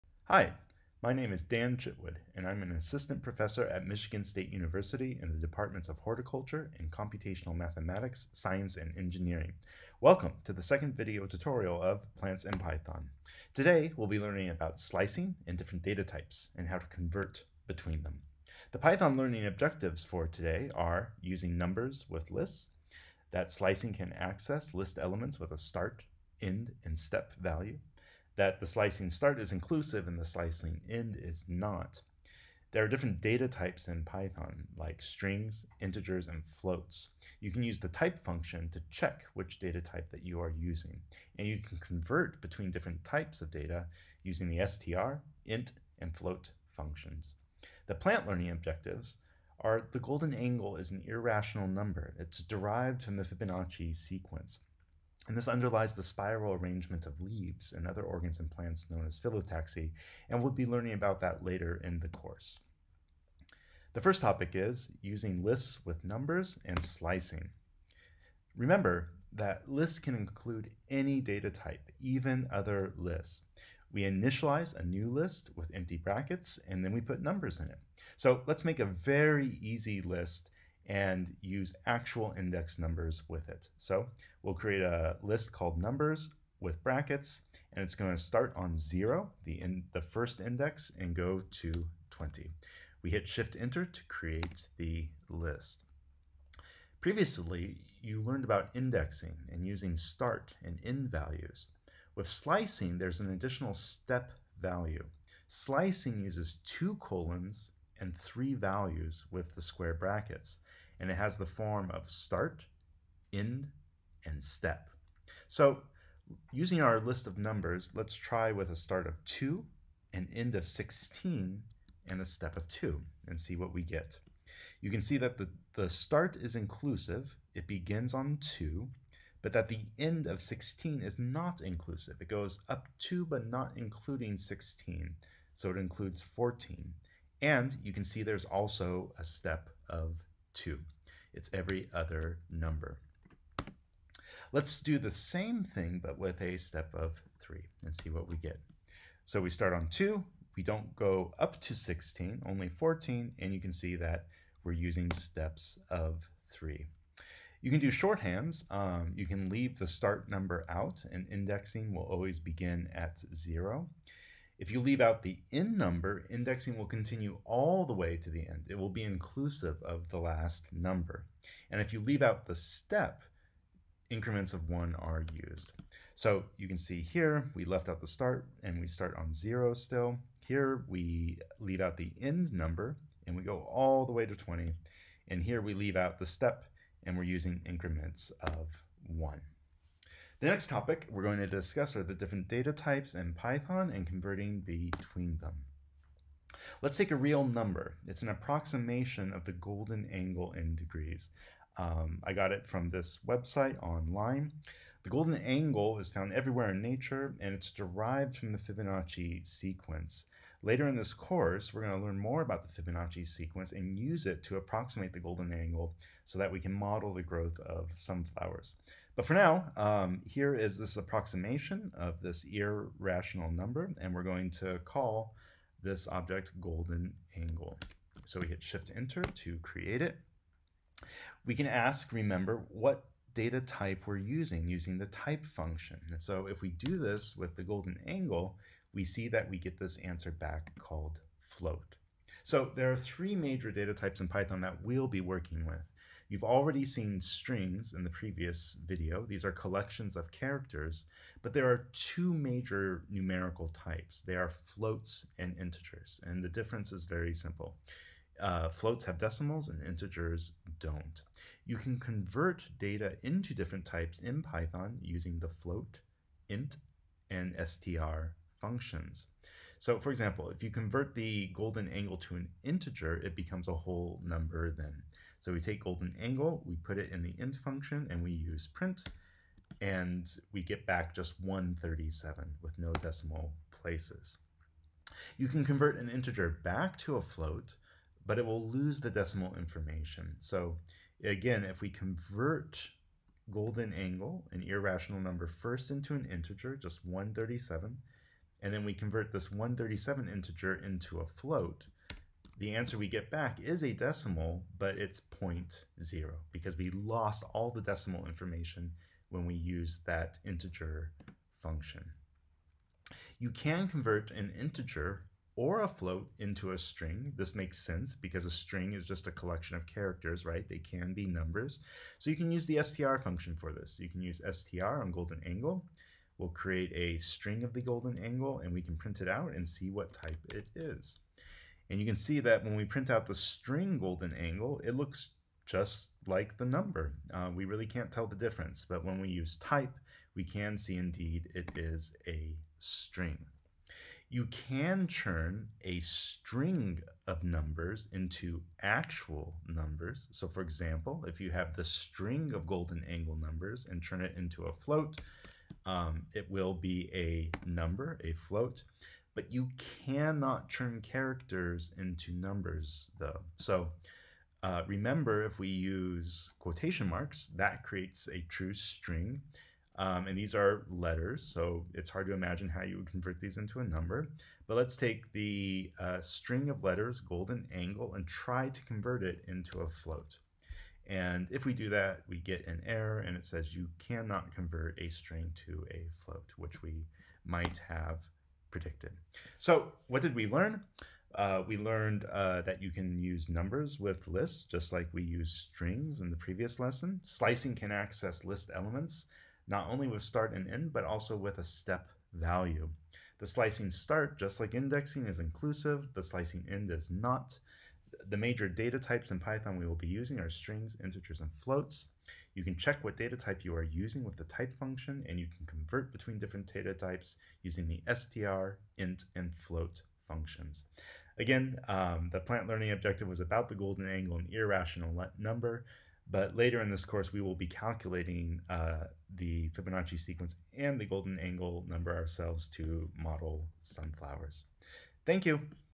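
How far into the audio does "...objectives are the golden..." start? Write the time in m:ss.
0:48.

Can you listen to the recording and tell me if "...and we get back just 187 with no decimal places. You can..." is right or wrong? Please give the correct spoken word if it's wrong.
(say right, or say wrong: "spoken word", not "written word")
wrong: "137", not "187".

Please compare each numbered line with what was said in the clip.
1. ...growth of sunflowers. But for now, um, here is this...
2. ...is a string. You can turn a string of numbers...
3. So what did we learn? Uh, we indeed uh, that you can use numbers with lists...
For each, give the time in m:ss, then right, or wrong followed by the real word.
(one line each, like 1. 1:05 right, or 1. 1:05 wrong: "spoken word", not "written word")
1. 3:37 right
2. 5:41 right
3. 6:29 wrong: "learned", not "indeed".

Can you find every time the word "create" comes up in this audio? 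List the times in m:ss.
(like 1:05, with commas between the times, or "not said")
1:24, 1:34, 3:49, 5:26, 6:07.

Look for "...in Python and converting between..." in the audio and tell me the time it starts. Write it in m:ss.
3:13.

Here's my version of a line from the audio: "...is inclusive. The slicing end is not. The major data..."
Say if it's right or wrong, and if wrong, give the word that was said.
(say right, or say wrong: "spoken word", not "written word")
right.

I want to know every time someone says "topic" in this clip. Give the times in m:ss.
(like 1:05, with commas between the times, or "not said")
1:04, 3:10.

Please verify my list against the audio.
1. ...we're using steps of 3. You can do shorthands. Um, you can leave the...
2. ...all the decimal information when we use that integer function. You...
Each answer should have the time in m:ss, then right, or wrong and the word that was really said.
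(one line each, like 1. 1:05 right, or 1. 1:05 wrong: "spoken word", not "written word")
1. 2:34 right
2. 5:07 right.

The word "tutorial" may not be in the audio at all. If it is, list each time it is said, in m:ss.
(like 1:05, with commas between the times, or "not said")
0:11.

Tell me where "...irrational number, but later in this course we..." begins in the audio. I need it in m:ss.
7:04.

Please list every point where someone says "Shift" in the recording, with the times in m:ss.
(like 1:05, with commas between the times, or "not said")
1:33, 3:48.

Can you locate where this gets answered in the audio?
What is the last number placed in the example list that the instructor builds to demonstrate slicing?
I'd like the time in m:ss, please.
1:31.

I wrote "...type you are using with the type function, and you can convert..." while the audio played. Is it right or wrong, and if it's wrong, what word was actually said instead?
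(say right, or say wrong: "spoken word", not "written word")
right.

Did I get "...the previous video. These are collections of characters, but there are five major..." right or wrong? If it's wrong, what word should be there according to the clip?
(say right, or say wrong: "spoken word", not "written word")
wrong: "two", not "five".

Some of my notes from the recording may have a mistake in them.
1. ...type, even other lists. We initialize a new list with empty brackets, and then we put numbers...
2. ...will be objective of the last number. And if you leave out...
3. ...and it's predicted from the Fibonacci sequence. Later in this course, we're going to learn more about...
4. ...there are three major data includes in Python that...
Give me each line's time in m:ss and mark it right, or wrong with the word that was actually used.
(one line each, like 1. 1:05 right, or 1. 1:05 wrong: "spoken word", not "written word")
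1. 1:11 right
2. 2:48 wrong: "inclusive", not "objective"
3. 3:27 wrong: "derived", not "predicted"
4. 4:02 wrong: "types", not "includes".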